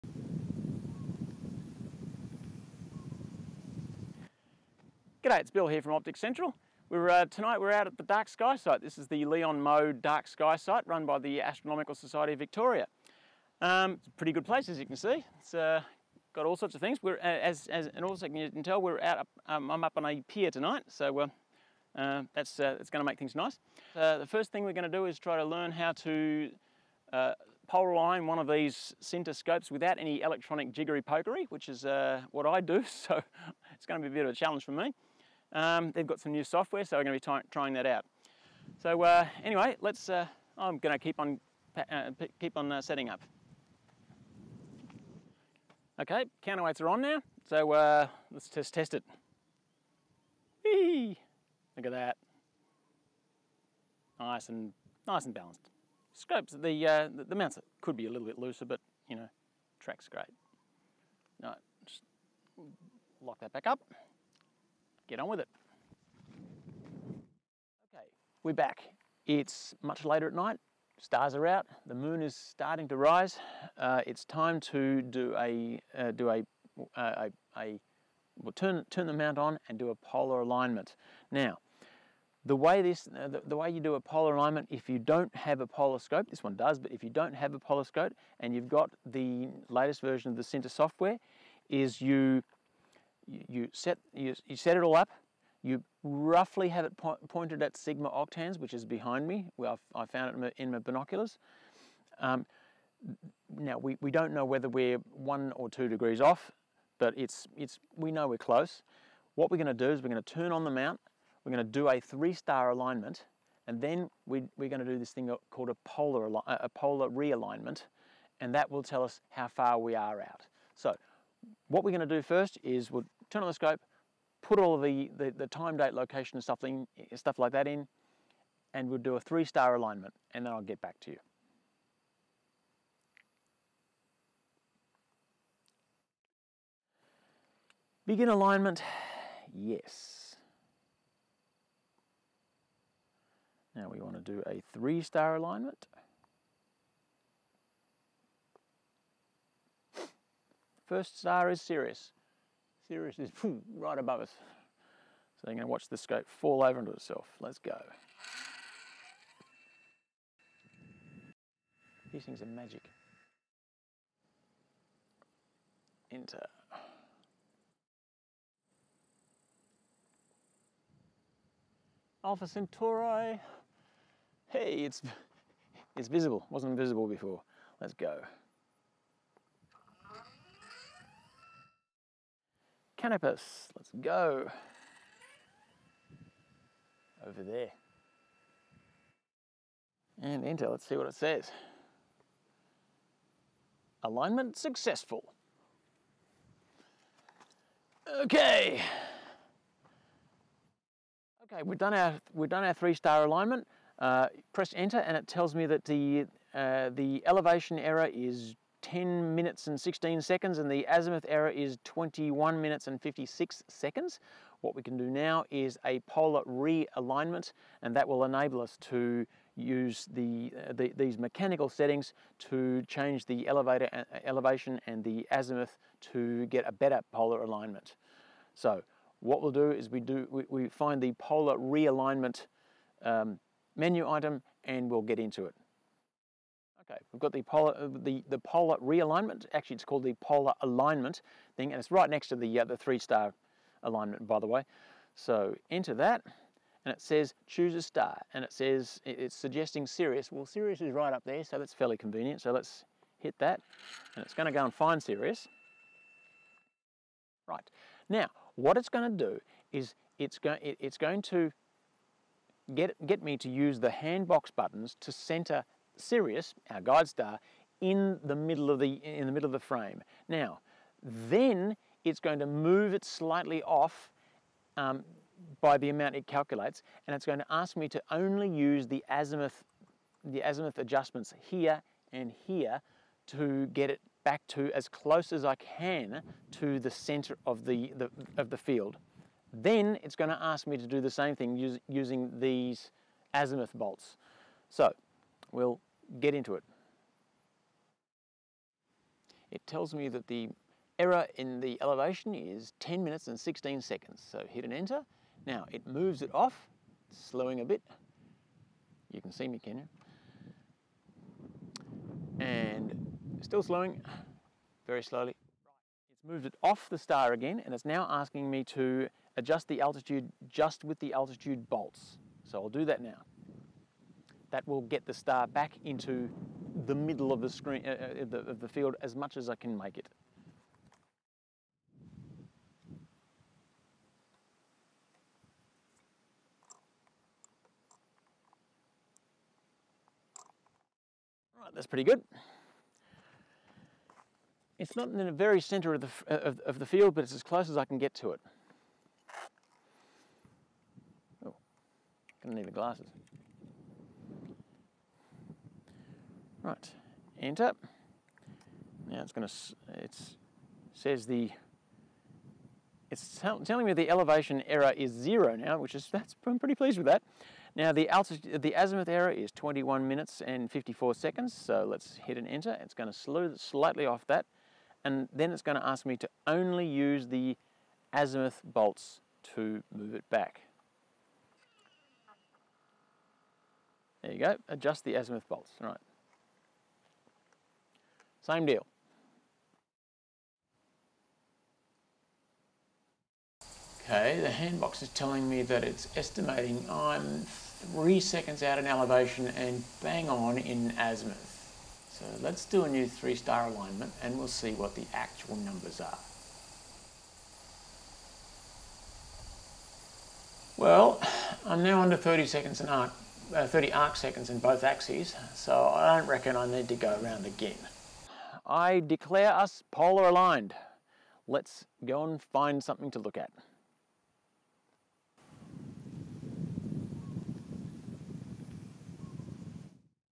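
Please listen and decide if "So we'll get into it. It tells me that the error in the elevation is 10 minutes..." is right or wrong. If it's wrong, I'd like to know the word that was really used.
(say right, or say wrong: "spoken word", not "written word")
right.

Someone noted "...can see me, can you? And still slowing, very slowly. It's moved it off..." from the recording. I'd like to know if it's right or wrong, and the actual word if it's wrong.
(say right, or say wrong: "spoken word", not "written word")
right.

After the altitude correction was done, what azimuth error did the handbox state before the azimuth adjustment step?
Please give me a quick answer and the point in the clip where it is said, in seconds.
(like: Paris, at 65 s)
21 minutes 54 seconds, at 369 s.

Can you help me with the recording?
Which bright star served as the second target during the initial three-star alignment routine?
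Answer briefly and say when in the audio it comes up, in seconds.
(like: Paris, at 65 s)
Alpha Centauri, at 172 s.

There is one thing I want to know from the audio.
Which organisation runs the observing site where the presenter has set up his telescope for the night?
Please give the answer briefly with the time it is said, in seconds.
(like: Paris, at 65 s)
Astronomical Society of Victoria, at 11 s.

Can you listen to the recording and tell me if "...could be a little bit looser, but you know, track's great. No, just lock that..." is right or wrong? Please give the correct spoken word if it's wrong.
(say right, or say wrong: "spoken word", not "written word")
right.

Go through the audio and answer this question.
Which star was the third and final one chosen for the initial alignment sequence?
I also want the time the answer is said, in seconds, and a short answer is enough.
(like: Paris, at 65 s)
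Canopus, at 183 s.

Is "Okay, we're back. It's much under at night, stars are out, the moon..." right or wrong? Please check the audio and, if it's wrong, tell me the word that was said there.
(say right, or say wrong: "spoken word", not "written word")
wrong: "later", not "under".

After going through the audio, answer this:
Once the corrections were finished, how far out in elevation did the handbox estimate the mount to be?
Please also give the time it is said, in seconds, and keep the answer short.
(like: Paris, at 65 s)
3 seconds, at 397 s.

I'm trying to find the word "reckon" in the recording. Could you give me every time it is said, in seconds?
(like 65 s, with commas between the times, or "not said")
416 s.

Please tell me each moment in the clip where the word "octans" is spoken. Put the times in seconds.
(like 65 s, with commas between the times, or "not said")
98 s.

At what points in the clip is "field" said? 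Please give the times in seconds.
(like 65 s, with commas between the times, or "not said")
288 s, 328 s, 346 s.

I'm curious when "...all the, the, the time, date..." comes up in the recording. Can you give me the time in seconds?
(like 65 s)
124 s.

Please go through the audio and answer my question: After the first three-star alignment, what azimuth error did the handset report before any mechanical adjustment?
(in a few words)
21 minutes 56 seconds.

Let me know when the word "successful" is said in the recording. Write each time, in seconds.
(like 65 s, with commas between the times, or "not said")
194 s.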